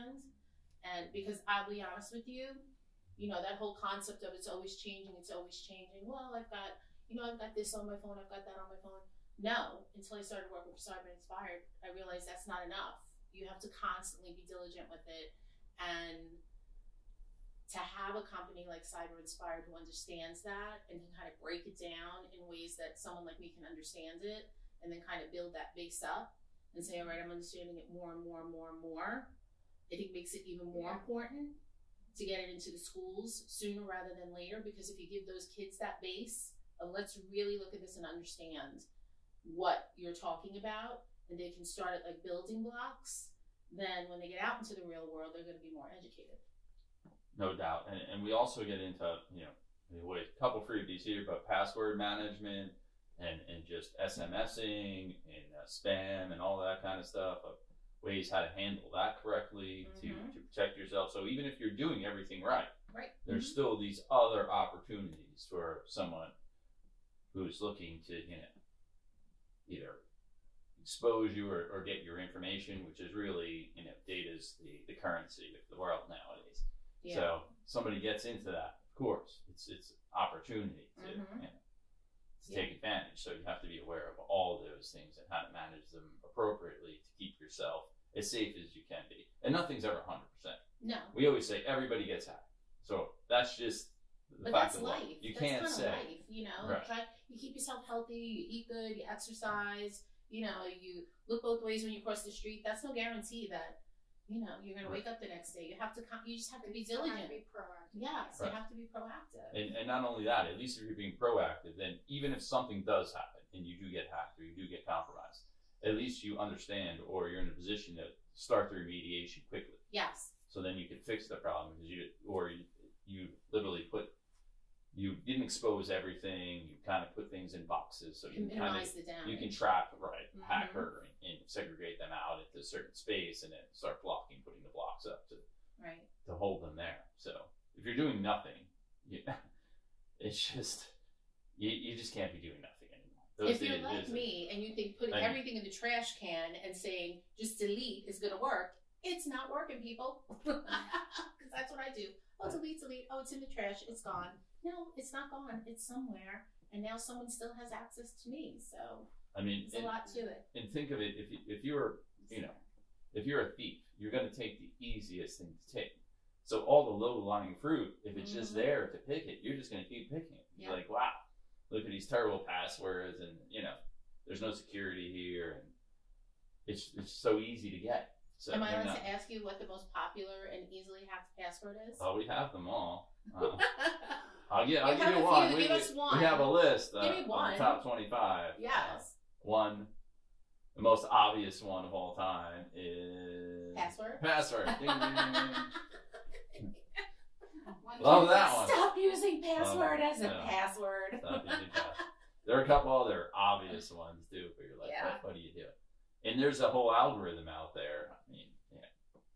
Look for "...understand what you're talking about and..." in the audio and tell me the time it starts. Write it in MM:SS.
00:38.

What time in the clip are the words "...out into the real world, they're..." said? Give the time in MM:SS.
00:44.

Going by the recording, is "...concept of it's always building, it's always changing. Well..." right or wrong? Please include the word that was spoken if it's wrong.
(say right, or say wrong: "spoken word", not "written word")
wrong: "changing", not "building".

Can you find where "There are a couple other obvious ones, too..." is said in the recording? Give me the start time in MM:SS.
03:22.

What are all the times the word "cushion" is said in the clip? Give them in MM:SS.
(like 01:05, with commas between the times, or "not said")
not said.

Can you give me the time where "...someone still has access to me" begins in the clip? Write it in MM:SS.
02:36.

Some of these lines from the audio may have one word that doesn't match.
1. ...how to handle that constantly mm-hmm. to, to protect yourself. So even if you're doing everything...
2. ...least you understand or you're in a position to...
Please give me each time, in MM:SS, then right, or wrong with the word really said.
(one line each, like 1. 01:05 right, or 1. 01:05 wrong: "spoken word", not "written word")
1. 00:58 wrong: "correctly", not "constantly"
2. 01:55 right.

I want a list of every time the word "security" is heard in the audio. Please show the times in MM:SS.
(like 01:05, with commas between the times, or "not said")
02:54.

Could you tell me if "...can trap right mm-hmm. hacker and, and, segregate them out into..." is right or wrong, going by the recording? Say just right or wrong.
right.